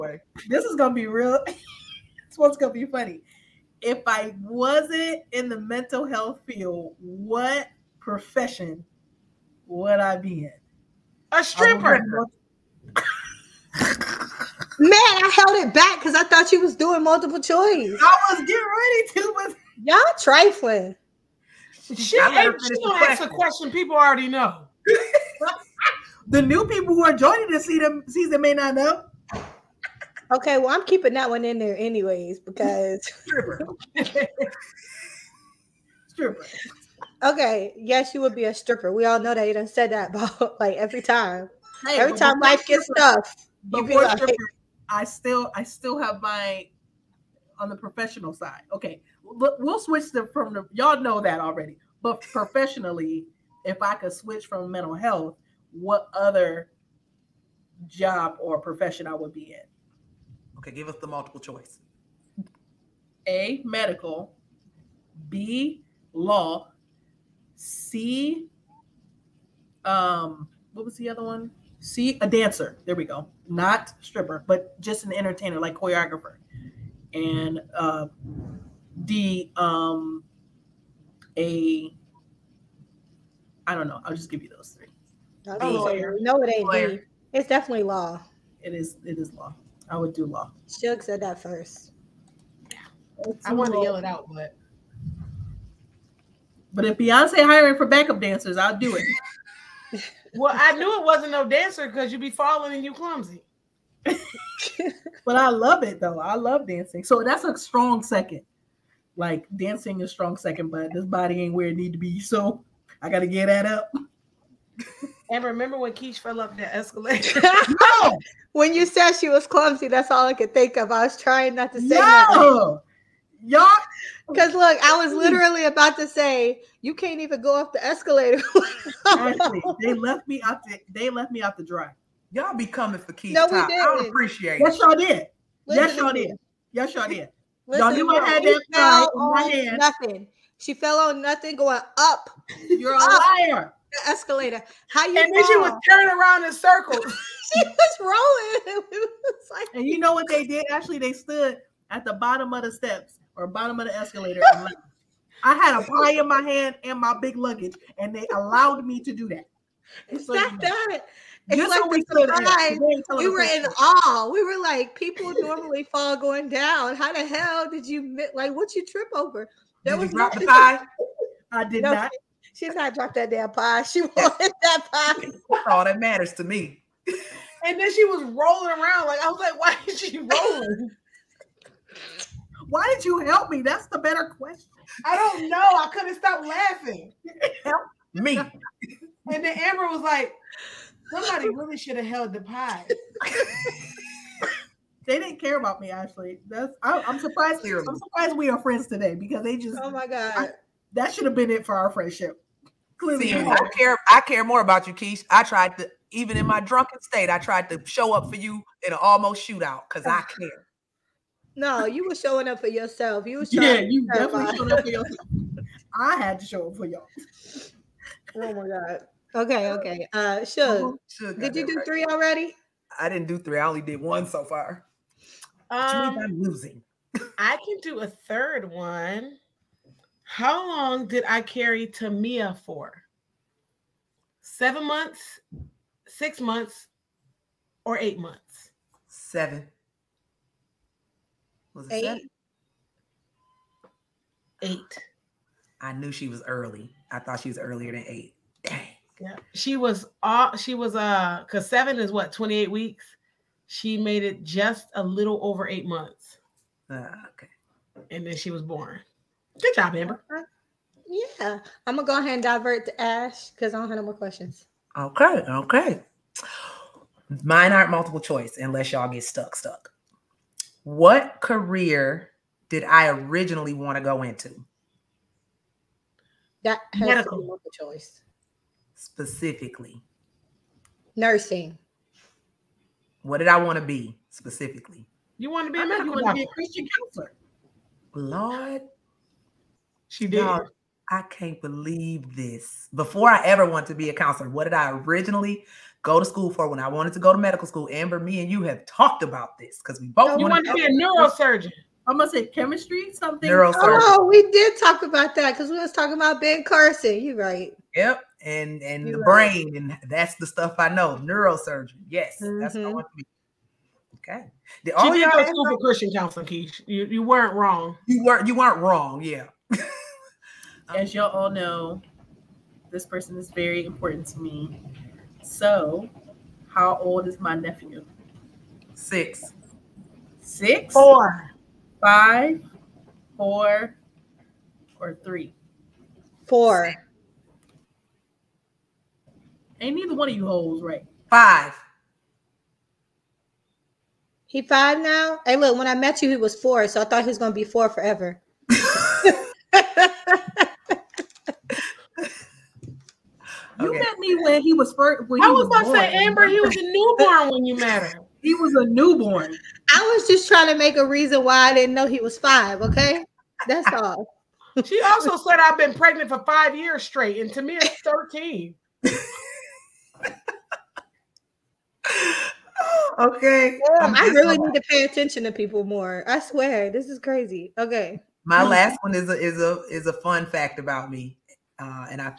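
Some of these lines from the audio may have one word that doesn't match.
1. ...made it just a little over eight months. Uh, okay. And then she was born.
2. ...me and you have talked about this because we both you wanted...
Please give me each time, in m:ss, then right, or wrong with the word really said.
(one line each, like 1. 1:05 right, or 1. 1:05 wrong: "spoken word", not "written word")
1. 4:13 right
2. 4:58 right.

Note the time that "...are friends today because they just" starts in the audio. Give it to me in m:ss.
3:18.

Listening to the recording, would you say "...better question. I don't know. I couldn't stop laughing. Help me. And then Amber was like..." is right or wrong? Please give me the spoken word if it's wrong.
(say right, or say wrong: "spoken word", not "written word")
right.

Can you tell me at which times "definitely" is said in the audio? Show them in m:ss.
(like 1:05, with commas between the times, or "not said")
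1:27, 3:34.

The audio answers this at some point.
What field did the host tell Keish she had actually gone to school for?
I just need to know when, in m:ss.
5:15.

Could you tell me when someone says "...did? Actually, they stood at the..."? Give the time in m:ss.
2:30.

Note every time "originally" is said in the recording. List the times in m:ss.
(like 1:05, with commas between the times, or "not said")
4:33, 4:54.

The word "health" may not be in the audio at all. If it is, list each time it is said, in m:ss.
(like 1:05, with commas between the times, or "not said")
0:06, 0:54.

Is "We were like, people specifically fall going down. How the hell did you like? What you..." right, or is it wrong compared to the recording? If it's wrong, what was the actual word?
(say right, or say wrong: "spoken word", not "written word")
wrong: "normally", not "specifically".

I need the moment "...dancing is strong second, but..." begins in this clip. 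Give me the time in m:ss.
1:49.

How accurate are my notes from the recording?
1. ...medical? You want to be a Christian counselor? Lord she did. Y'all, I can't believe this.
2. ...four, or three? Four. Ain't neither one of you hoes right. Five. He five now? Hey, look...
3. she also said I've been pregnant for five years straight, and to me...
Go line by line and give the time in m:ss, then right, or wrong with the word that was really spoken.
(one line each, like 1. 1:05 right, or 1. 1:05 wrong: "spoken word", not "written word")
1. 4:45 right
2. 5:33 right
3. 6:04 right.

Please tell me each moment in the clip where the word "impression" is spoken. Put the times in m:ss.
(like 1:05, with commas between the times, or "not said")
not said.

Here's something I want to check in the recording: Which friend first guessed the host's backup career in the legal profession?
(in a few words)
Shug.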